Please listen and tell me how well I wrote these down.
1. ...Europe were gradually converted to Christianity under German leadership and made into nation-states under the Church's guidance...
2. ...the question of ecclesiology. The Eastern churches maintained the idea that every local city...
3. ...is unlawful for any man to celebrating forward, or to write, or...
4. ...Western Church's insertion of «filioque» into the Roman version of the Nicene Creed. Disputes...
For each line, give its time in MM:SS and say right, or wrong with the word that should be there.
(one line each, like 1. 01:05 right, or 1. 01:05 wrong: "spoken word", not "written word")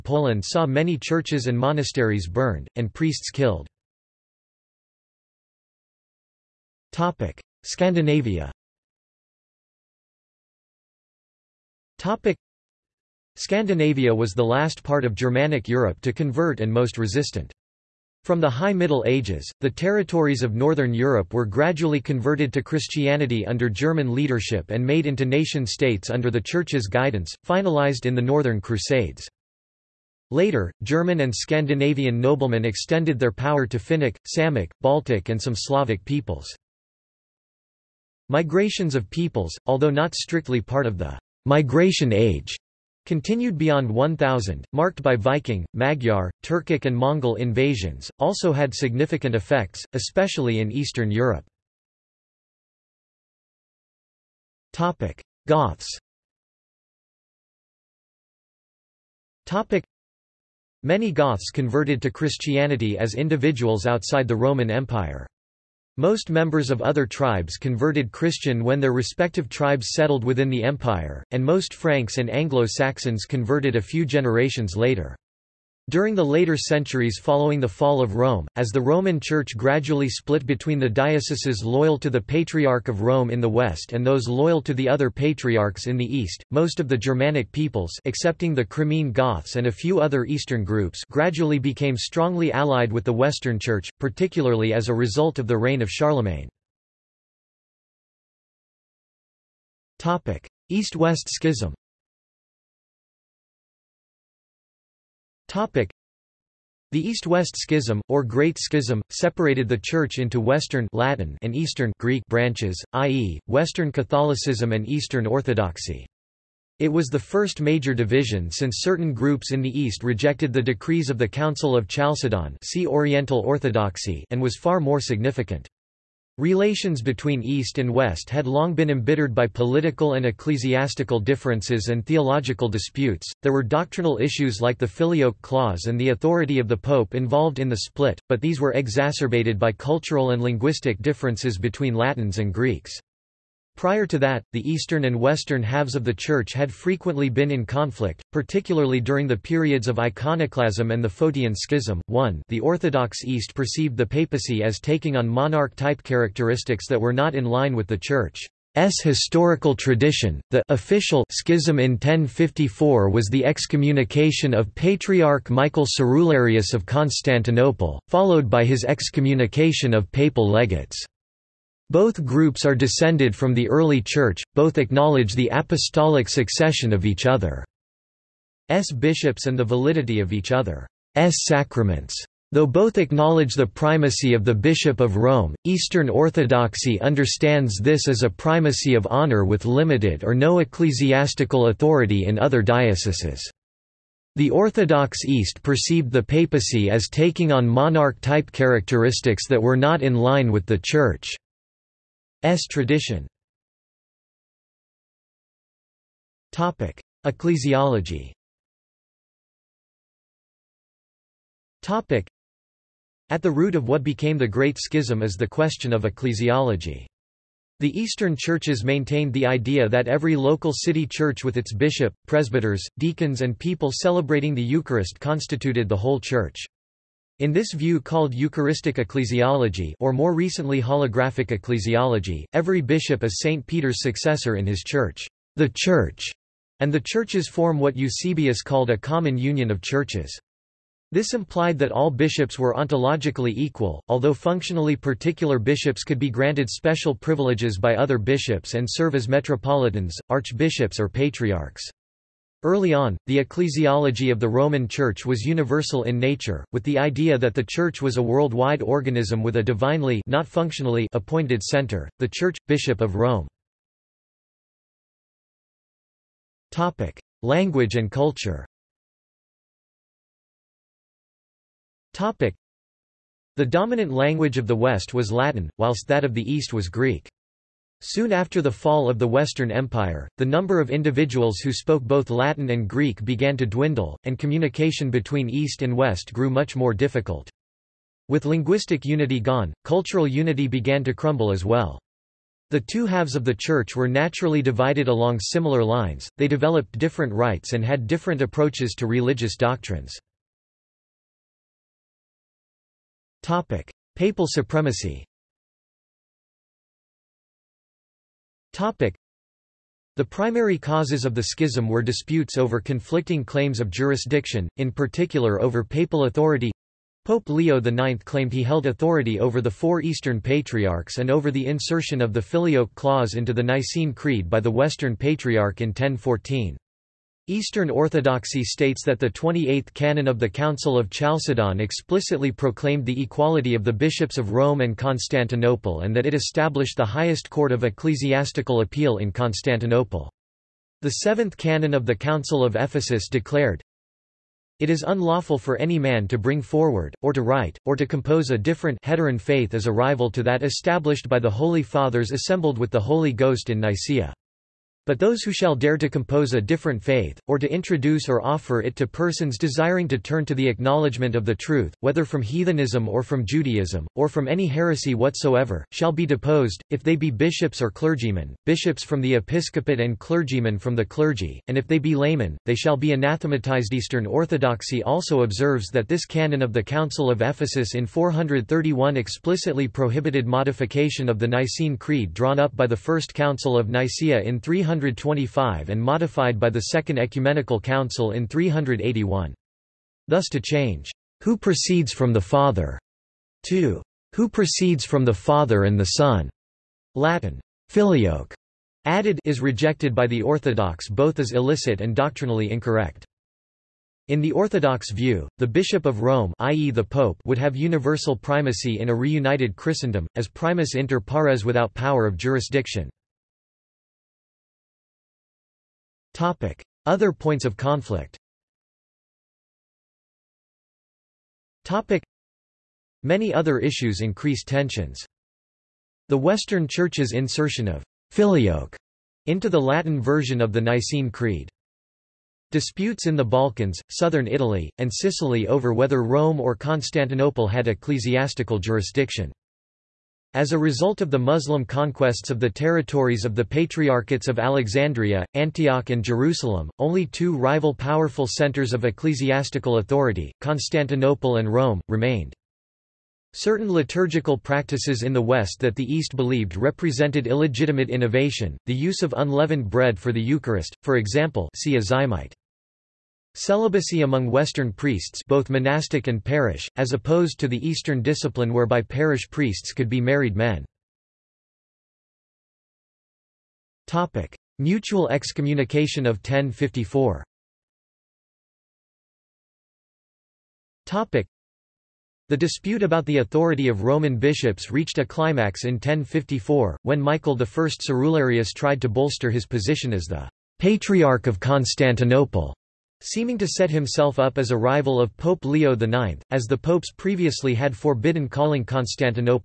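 1. 00:20 right
2. 03:35 right
3. 05:44 wrong: "bring", not "celebrating"
4. 07:06 wrong: "Latin", not "Roman".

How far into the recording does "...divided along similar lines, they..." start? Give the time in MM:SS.
04:54.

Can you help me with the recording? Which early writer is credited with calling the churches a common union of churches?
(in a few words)
Eusebius.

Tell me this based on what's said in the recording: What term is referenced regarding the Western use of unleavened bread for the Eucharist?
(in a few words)
azymite.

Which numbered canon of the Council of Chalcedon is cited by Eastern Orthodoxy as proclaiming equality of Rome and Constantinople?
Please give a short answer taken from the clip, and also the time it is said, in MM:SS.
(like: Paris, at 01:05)
28th, at 05:29.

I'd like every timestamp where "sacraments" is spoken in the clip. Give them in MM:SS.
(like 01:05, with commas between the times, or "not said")
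03:01.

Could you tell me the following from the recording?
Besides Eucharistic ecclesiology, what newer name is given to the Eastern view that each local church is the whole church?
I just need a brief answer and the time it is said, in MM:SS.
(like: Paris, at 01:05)
holographic ecclesiology, at 03:50.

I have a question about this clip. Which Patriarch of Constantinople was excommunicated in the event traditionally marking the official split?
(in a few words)
Michael Cerularius.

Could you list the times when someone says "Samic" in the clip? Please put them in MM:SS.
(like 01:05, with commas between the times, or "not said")
00:34.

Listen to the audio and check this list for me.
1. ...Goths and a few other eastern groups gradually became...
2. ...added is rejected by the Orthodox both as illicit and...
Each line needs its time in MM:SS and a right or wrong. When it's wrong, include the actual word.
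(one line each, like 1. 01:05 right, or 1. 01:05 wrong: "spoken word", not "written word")
1. 01:29 right
2. 06:39 right.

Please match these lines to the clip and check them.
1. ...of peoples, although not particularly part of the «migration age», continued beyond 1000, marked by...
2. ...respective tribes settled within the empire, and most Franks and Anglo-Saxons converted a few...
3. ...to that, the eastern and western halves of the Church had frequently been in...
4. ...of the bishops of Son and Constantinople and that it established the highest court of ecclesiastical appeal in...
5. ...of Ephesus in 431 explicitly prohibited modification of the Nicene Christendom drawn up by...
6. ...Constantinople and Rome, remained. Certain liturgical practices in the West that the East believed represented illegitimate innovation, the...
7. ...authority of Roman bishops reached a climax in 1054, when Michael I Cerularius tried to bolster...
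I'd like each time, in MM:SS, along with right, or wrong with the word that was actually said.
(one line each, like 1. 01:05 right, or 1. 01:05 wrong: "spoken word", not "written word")
1. 00:38 wrong: "strictly", not "particularly"
2. 01:08 right
3. 02:24 right
4. 05:33 wrong: "Rome", not "Son"
5. 06:17 wrong: "Creed", not "Christendom"
6. 07:30 right
7. 08:03 right.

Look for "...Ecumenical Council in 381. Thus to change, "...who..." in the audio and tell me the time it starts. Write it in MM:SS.
06:27.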